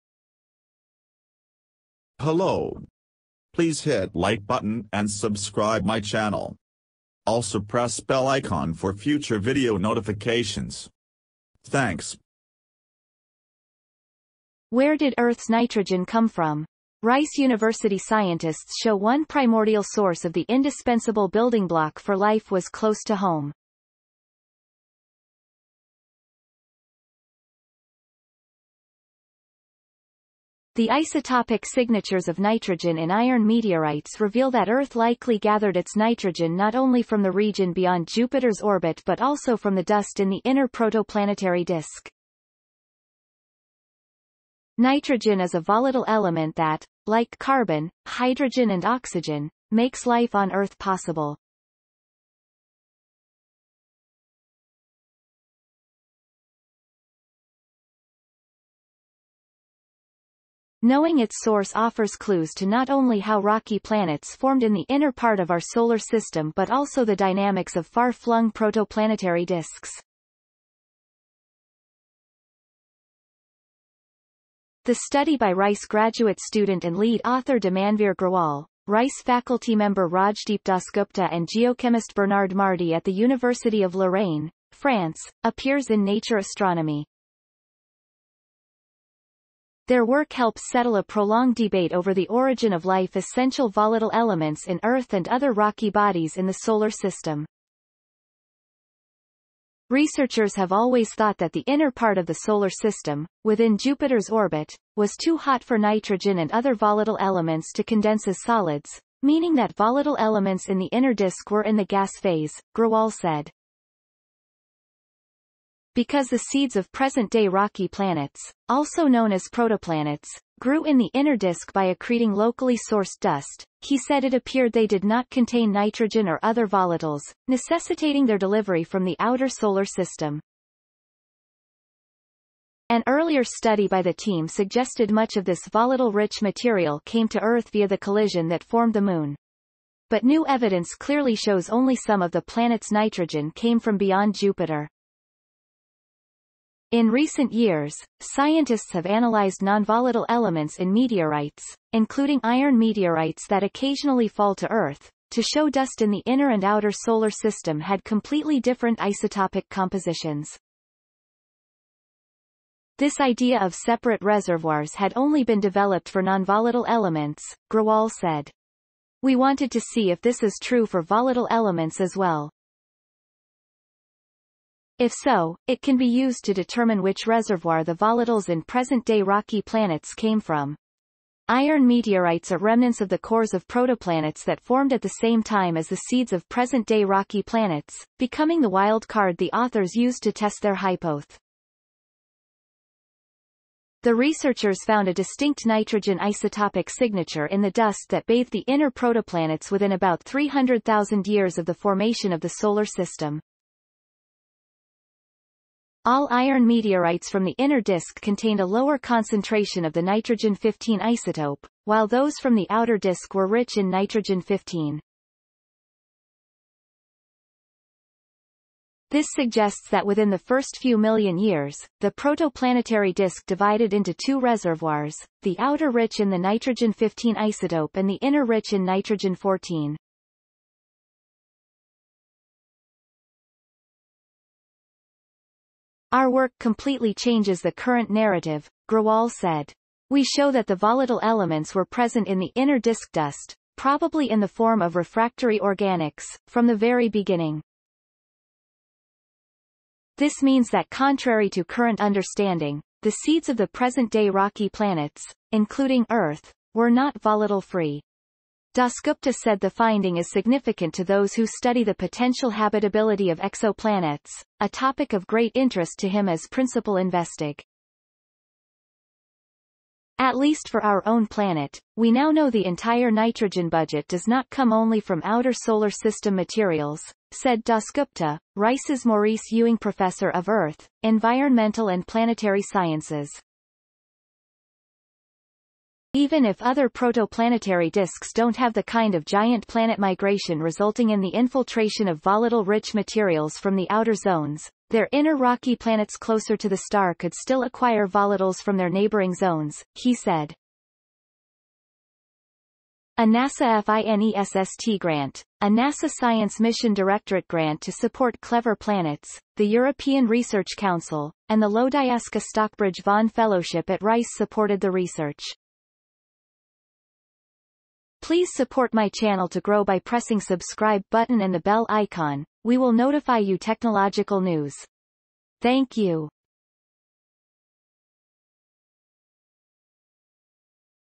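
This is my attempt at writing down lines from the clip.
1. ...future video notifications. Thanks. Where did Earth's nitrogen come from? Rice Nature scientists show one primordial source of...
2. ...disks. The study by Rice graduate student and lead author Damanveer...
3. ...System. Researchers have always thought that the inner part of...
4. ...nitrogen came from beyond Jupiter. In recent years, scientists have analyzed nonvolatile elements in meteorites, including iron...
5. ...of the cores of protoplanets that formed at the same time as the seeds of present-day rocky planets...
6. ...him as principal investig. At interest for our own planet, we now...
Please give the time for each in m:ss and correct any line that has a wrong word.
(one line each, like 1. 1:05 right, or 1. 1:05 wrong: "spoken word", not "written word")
1. 0:08 wrong: "University", not "Nature"
2. 1:09 right
3. 1:36 right
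4. 2:22 right
5. 3:03 right
6. 4:26 wrong: "least", not "interest".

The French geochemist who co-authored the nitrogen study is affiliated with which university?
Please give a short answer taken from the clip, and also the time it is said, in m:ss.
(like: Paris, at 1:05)
University of Lorraine, at 1:23.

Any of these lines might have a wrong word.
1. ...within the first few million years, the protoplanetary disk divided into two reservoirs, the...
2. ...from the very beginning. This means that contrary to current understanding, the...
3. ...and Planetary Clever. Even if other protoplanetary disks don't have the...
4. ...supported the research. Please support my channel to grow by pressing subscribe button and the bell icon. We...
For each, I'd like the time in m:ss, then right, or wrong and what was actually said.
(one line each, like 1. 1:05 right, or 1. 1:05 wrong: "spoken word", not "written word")
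1. 3:40 right
2. 4:06 right
3. 4:41 wrong: "Sciences", not "Clever"
4. 5:14 right.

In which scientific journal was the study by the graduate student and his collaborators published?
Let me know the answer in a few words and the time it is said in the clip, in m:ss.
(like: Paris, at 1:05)
Nature Astronomy, at 1:26.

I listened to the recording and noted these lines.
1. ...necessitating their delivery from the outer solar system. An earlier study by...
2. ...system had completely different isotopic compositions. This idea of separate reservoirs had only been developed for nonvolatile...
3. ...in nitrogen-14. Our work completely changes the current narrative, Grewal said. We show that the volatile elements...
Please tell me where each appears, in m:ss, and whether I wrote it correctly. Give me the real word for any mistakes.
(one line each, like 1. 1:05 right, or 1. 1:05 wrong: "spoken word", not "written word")
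1. 2:07 right
2. 2:37 right
3. 3:48 right.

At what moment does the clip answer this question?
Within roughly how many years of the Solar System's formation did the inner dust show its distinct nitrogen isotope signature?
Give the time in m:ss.
3:20.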